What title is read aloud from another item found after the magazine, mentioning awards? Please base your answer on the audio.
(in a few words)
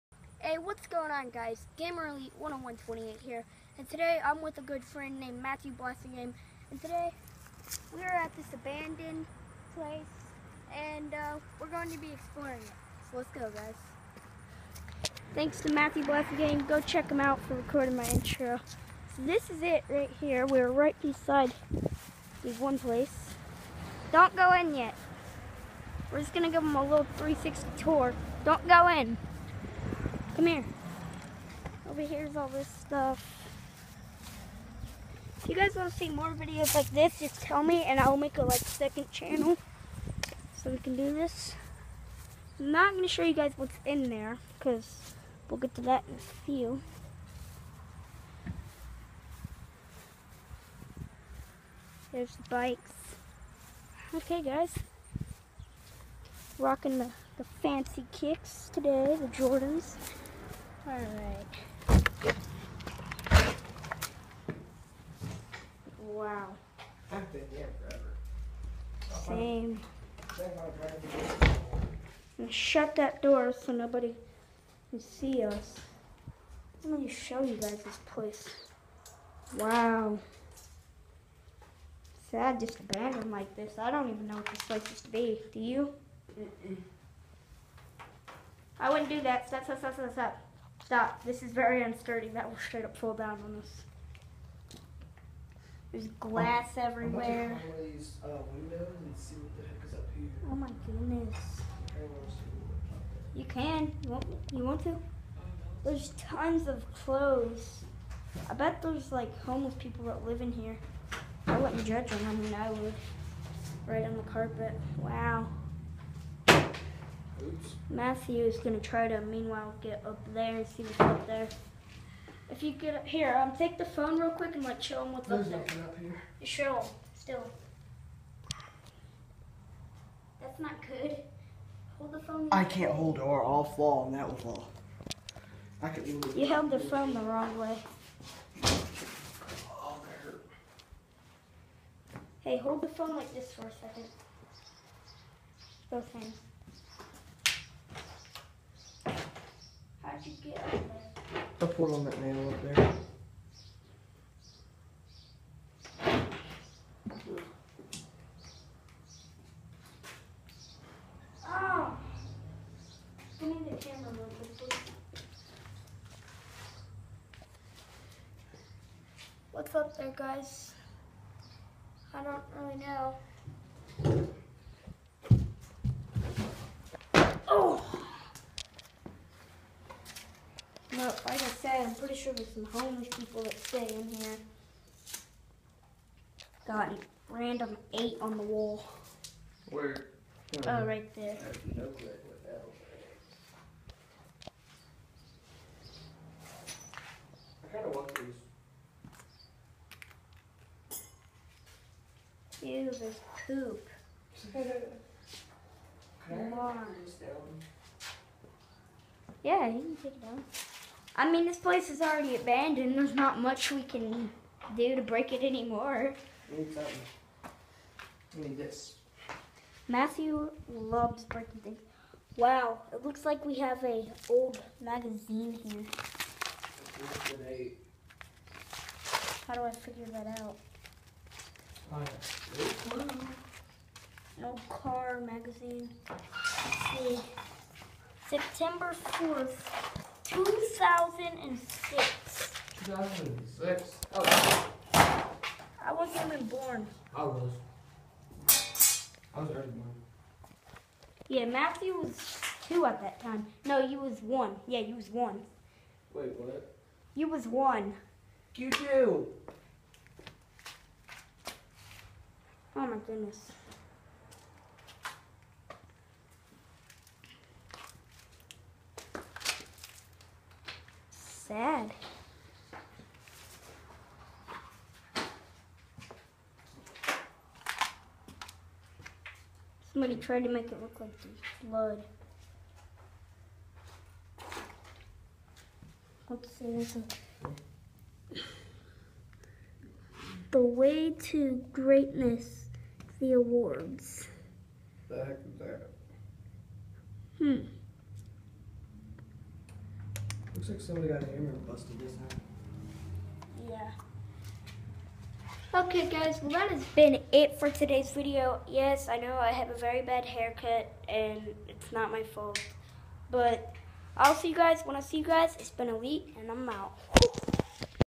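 The Way to Greatness.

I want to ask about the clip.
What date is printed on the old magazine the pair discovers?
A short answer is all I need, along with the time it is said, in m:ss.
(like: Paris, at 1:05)
September 4th, 2006, at 3:58.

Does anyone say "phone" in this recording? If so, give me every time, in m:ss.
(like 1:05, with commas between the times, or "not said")
2:03, 2:12, 2:16, 2:22.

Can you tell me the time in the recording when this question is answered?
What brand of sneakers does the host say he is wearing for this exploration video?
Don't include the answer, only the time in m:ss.
0:59.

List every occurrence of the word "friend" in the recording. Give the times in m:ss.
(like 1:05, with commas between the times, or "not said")
0:04.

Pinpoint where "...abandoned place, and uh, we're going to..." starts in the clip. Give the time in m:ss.
0:08.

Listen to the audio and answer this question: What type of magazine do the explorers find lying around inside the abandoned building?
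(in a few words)
Car magazine.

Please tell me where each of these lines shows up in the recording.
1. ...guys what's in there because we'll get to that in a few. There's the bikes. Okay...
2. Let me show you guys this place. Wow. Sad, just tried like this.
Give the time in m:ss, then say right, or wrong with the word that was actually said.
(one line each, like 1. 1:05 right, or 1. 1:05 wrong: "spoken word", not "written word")
1. 0:43 right
2. 1:16 wrong: "abandoned", not "tried".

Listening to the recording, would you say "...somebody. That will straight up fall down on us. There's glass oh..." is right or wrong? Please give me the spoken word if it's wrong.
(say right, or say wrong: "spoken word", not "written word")
wrong: "unsteady", not "somebody".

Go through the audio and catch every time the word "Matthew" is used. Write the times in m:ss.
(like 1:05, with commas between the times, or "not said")
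0:05, 0:15, 1:57, 3:39, 4:11.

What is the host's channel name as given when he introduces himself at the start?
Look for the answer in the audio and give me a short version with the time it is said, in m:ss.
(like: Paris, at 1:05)
Gamer Elite 10128, at 0:01.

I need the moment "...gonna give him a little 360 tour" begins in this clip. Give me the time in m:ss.
0:26.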